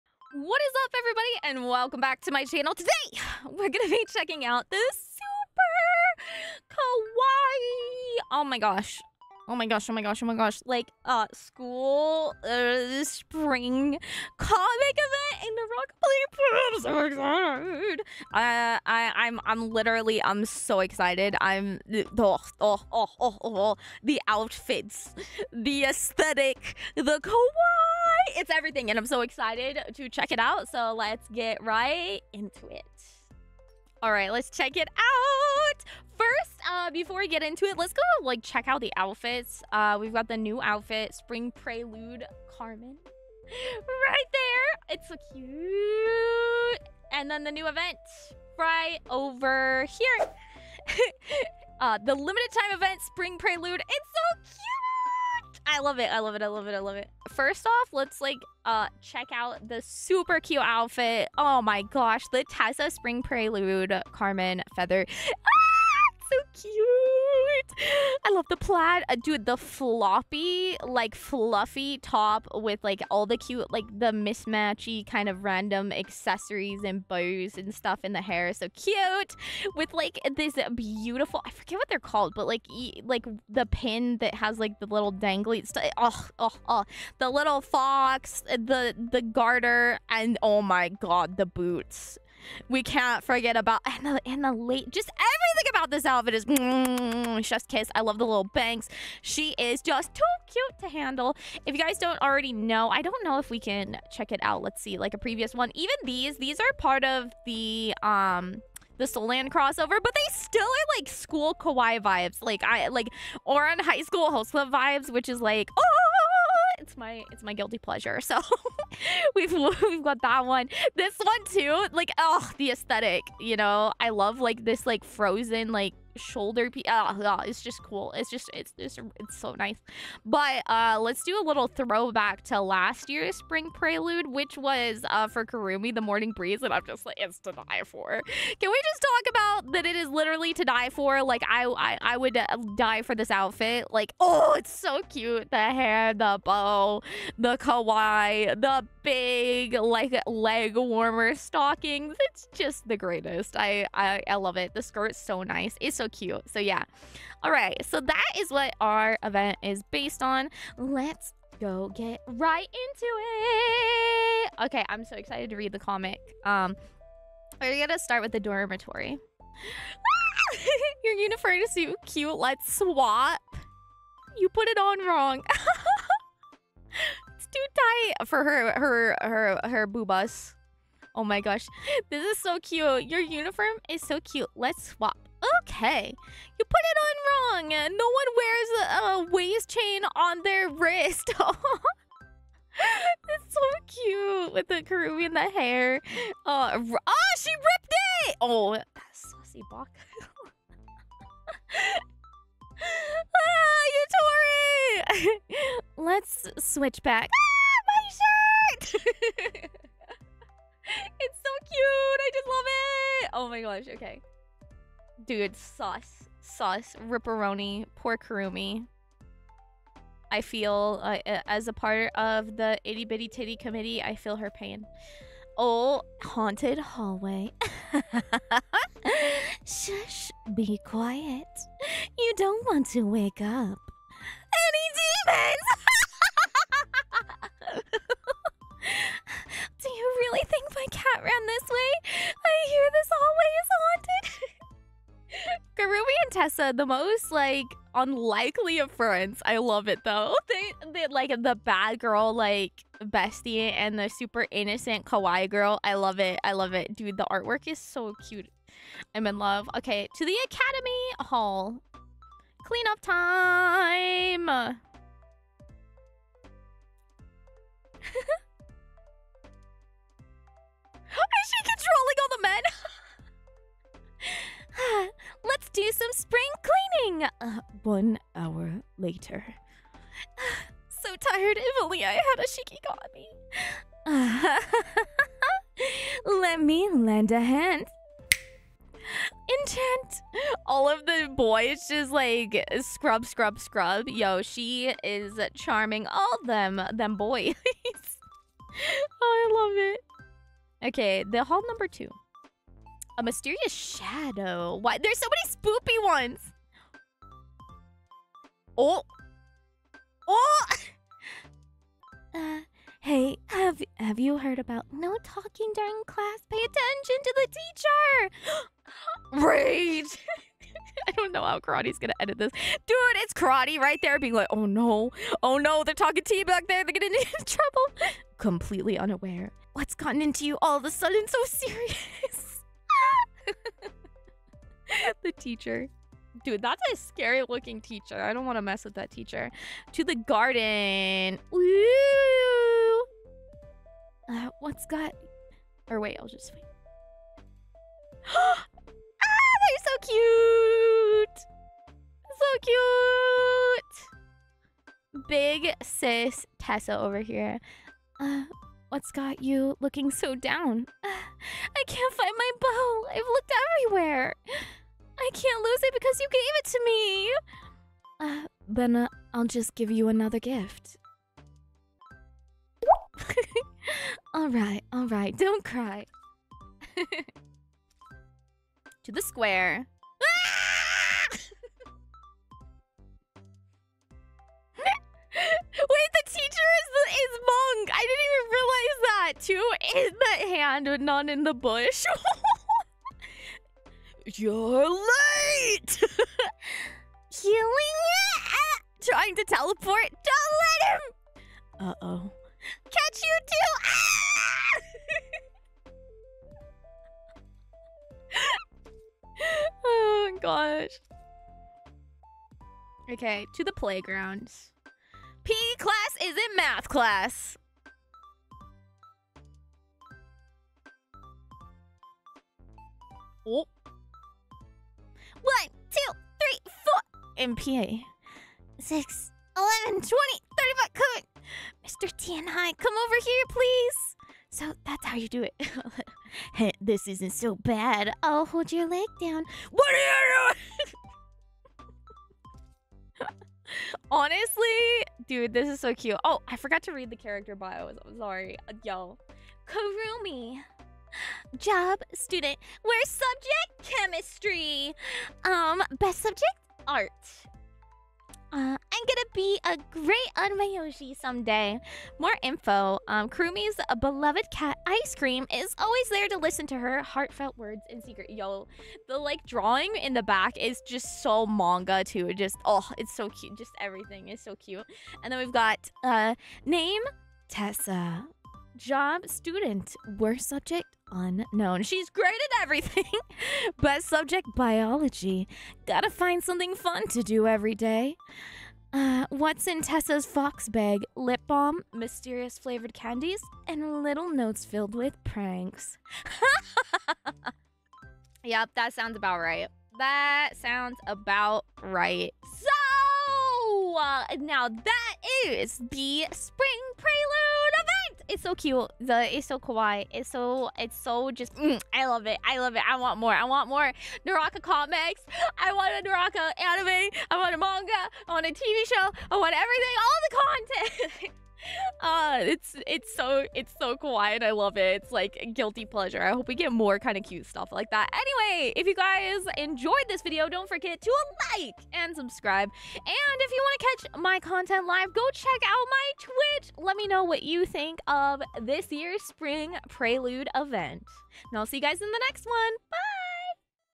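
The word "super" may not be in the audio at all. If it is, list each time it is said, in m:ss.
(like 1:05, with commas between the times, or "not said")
0:04, 0:59, 4:14.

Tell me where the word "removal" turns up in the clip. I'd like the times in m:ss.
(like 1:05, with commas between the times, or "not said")
not said.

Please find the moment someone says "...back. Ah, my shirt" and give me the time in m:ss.
3:27.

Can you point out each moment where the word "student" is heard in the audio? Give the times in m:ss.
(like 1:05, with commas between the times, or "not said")
7:32, 7:59.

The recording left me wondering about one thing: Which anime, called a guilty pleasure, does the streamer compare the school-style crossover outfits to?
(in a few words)
Ouran High School Host Club.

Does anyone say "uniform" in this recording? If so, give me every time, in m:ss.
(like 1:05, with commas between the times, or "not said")
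2:51, 3:03.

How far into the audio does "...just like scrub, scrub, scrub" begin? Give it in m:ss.
4:51.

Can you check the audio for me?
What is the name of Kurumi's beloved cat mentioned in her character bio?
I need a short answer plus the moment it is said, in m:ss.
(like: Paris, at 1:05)
Ice Cream, at 7:44.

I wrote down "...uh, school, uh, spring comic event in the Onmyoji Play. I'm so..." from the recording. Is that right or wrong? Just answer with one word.
wrong.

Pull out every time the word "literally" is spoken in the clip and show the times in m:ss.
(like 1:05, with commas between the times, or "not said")
0:19, 2:20.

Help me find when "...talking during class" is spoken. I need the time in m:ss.
5:15.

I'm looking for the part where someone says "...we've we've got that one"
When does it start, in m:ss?
1:59.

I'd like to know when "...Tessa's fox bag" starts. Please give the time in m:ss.
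8:09.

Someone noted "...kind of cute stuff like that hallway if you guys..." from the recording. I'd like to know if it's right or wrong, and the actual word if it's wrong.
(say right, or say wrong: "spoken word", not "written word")
wrong: "anyway", not "hallway".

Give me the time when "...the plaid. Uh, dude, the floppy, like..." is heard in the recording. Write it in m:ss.
1:08.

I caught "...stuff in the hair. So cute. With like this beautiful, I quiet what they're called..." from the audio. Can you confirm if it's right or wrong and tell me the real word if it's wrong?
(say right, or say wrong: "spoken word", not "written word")
wrong: "forget", not "quiet".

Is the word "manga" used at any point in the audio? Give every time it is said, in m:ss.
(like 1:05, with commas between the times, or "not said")
7:51, 8:37.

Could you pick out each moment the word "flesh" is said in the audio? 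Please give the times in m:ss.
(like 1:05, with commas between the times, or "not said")
not said.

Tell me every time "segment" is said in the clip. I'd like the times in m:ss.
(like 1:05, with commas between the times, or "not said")
not said.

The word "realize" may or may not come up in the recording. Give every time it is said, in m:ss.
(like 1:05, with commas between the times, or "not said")
6:29.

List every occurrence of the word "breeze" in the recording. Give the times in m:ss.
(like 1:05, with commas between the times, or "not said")
2:16.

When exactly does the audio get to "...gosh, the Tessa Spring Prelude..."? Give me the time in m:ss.
1:01.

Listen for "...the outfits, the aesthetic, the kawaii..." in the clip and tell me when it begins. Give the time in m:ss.
0:24.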